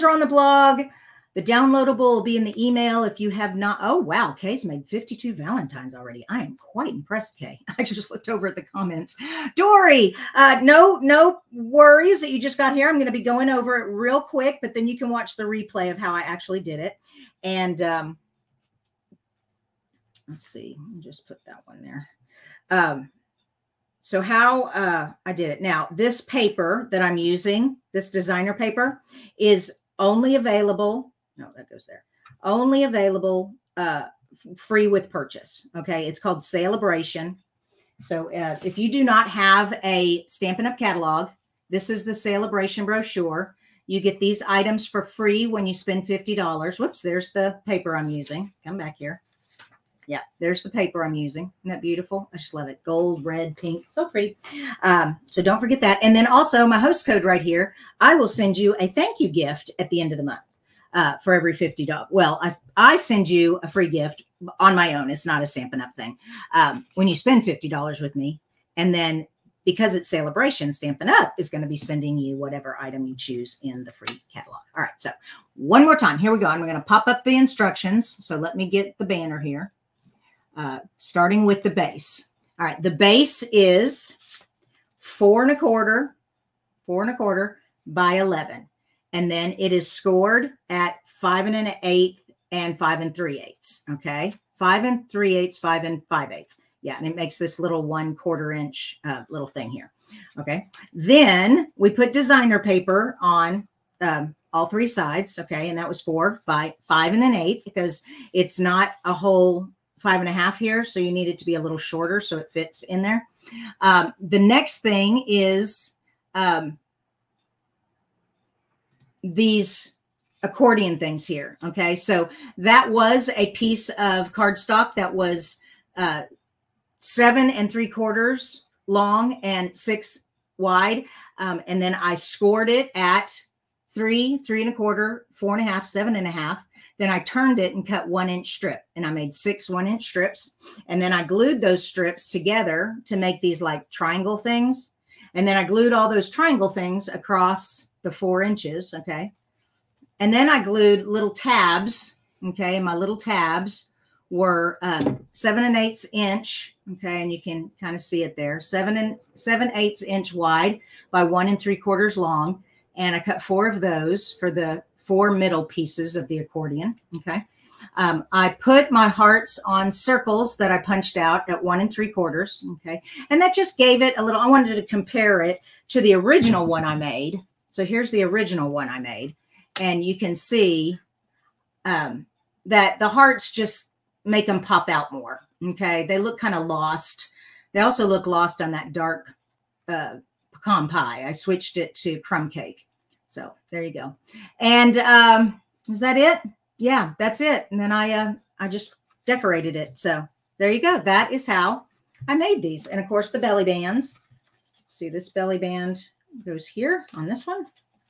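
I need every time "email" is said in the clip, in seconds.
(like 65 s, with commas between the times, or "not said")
2 s.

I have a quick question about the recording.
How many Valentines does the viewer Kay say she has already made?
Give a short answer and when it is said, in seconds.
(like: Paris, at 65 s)
52, at 4 s.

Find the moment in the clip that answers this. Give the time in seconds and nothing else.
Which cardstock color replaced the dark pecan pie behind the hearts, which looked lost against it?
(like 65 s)
192 s.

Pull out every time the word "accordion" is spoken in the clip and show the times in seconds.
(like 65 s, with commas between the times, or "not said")
120 s, 166 s.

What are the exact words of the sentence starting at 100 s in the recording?
Okay, then we put designer paper on um, all three sides.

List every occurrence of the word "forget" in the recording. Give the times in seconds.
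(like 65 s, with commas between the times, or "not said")
55 s.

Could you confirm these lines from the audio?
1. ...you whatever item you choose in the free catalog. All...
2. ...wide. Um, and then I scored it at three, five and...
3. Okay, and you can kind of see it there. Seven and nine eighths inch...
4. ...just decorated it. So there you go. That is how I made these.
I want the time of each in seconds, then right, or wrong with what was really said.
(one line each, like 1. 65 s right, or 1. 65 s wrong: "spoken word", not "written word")
1. 72 s right
2. 130 s wrong: "three", not "five"
3. 156 s wrong: "seven", not "nine"
4. 198 s right.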